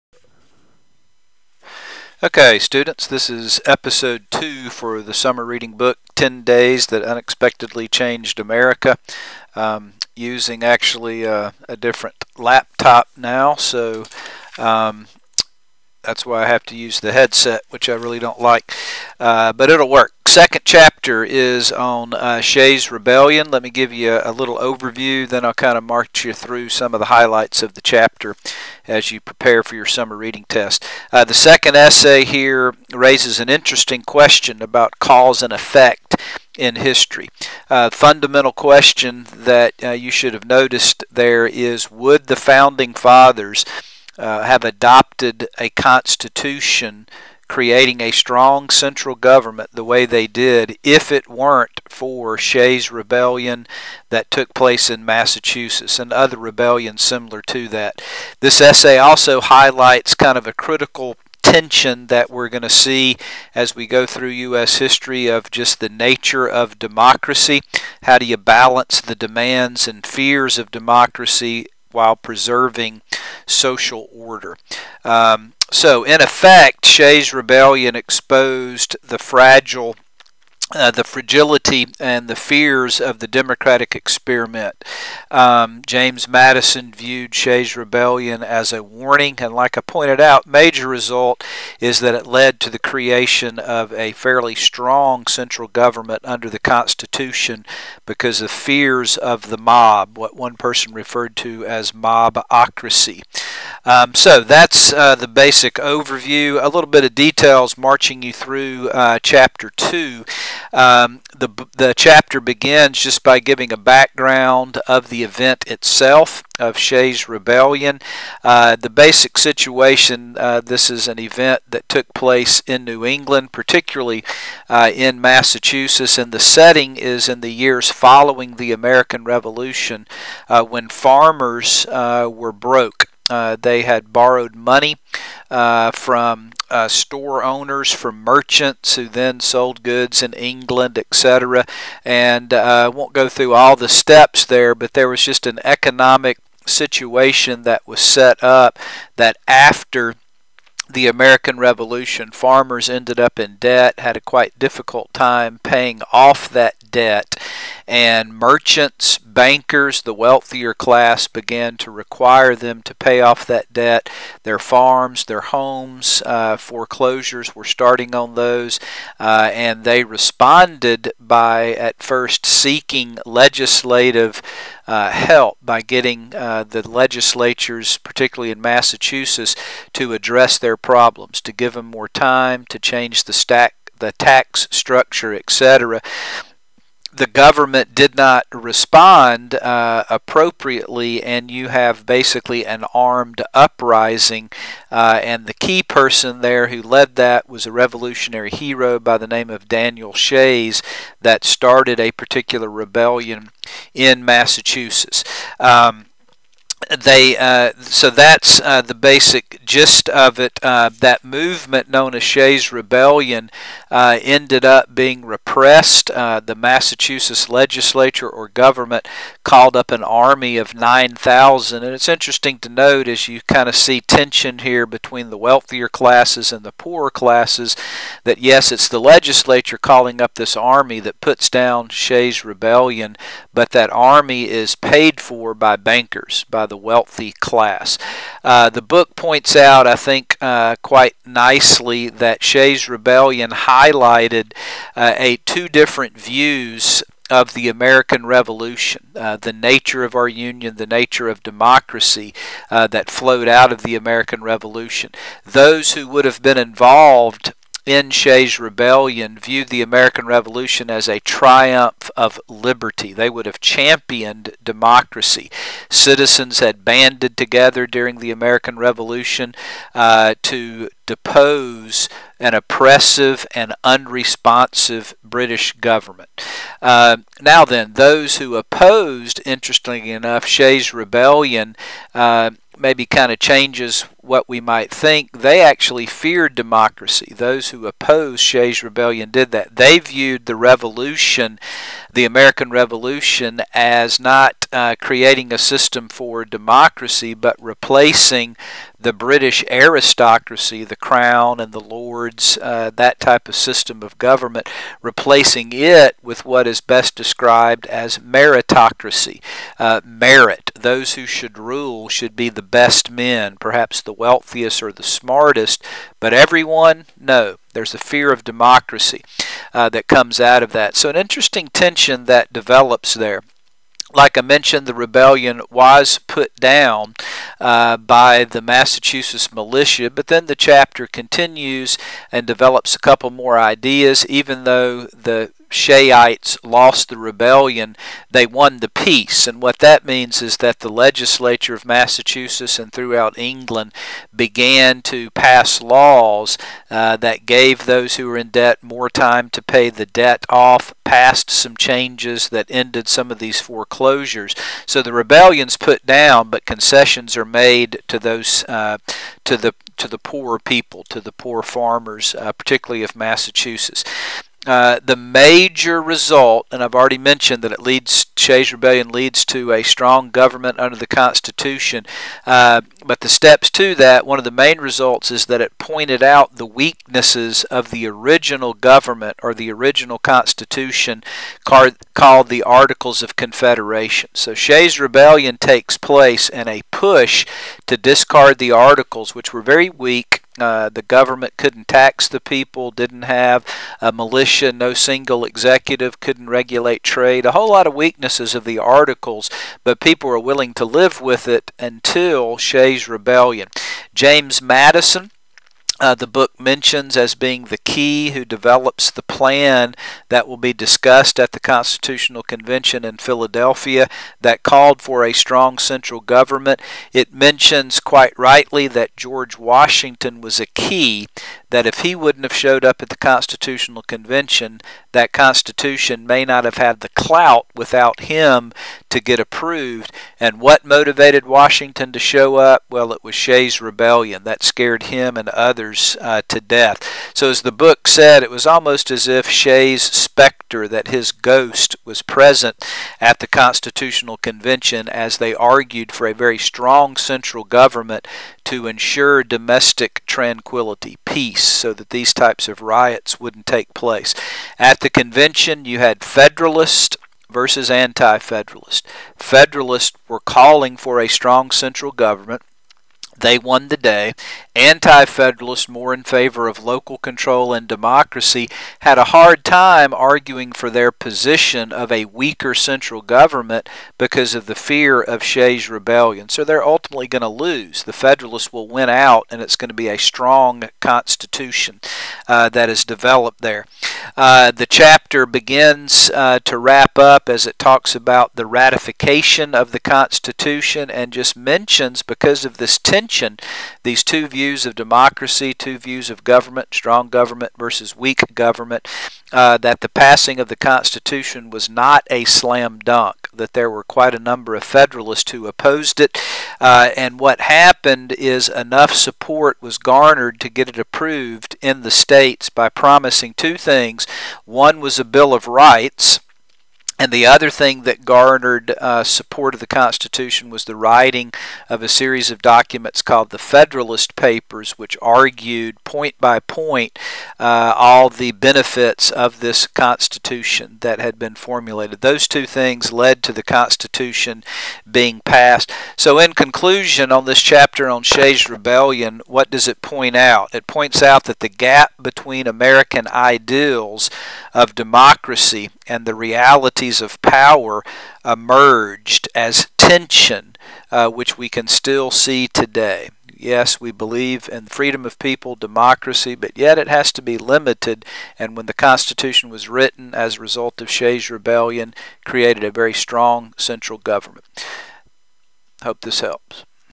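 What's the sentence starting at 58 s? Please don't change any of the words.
This essay also highlights kind of a critical tension that we're going to see as we go through U.S.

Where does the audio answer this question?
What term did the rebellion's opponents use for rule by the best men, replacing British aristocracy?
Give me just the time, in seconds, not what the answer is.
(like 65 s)
308 s.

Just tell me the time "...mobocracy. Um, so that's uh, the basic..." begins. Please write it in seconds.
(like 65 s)
101 s.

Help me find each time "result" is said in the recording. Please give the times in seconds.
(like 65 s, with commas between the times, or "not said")
90 s, 366 s, 374 s, 560 s.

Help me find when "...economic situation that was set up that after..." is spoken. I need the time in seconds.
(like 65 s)
145 s.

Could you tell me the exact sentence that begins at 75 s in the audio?
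Um, so, in effect, Shays' rebellion exposed the fragile uh, the fragility and the fears of the democratic experiment.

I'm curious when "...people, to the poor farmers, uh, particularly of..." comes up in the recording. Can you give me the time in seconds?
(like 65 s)
360 s.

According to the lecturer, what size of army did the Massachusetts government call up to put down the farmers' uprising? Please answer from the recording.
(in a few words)
9,000.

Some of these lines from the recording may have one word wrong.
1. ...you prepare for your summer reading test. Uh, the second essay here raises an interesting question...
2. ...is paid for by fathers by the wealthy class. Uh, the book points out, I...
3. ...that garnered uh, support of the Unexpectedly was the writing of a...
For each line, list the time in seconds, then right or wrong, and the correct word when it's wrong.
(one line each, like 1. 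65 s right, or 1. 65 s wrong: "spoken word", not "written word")
1. 29 s right
2. 234 s wrong: "bankers", not "fathers"
3. 518 s wrong: "Constitution", not "Unexpectedly".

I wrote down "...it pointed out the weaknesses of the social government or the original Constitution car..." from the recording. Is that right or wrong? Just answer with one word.
wrong.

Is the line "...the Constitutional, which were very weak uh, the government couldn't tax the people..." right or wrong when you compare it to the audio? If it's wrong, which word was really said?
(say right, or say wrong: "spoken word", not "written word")
wrong: "Articles", not "Constitutional".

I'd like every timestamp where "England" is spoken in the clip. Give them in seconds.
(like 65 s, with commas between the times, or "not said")
123 s, 140 s, 343 s.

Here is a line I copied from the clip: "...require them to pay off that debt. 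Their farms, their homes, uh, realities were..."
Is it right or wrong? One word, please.
wrong.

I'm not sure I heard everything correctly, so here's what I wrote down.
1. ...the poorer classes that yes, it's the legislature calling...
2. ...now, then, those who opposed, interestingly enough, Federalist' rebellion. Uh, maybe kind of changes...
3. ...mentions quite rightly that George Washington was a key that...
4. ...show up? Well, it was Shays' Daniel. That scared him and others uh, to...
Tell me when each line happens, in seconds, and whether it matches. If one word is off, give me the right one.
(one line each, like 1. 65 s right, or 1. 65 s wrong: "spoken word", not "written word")
1. 226 s right
2. 277 s wrong: "Shays", not "Federalist"
3. 417 s right
4. 432 s wrong: "Rebellion", not "Daniel".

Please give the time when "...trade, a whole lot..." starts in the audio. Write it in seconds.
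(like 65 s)
397 s.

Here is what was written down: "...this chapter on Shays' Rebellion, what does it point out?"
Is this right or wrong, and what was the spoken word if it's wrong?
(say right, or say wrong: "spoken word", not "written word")
right.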